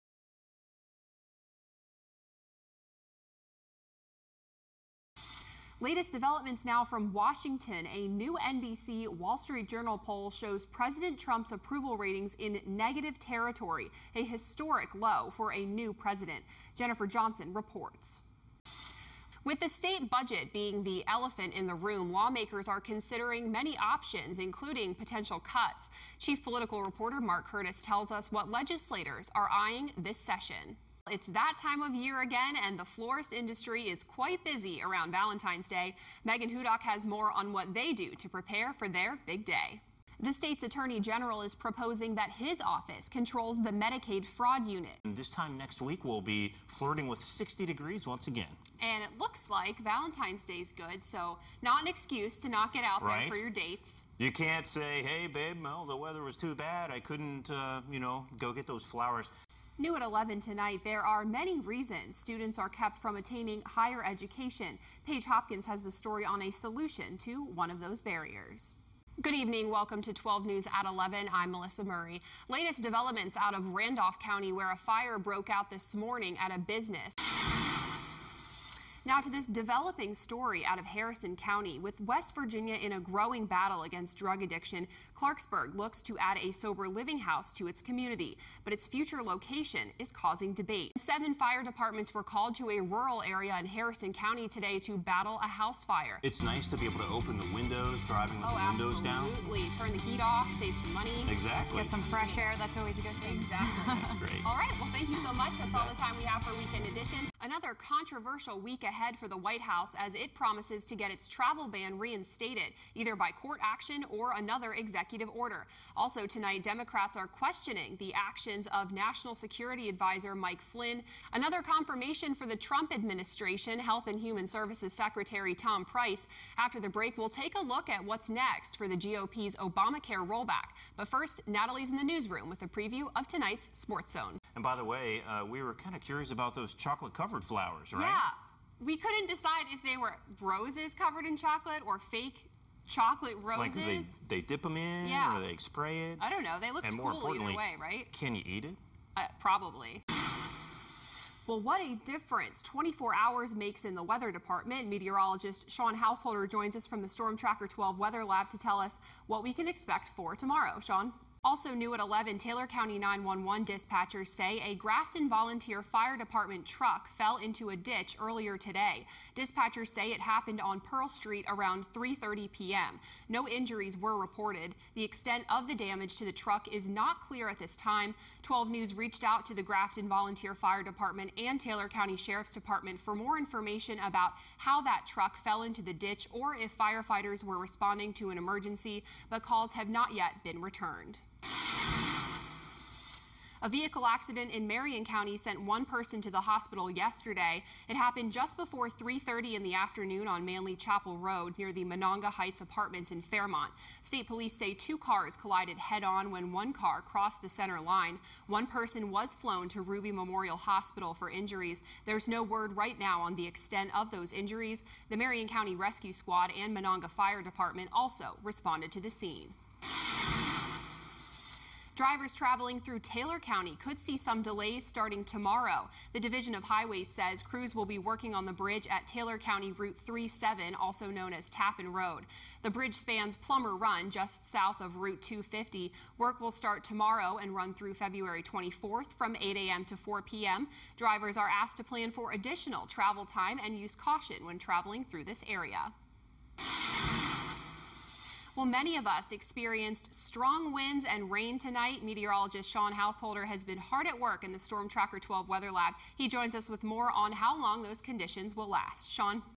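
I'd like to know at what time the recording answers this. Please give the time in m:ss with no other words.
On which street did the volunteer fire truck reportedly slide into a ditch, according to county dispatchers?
2:50.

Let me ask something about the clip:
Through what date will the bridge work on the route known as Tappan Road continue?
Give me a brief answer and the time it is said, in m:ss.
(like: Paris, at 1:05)
February 24th, at 3:57.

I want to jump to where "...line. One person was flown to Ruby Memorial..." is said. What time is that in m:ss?
3:27.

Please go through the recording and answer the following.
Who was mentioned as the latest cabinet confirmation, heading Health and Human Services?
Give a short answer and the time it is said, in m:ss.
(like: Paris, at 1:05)
Tom Price, at 2:05.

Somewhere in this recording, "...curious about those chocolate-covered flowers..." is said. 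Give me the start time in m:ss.
2:16.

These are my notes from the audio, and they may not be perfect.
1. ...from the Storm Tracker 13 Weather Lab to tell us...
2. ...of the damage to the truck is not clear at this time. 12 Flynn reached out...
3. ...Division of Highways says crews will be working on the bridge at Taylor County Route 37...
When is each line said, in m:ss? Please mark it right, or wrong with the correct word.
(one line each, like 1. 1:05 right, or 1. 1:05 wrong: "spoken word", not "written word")
1. 2:36 wrong: "12", not "13"
2. 2:55 wrong: "News", not "Flynn"
3. 3:46 right.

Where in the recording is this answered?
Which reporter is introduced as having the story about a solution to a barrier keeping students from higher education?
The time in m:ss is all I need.
1:05.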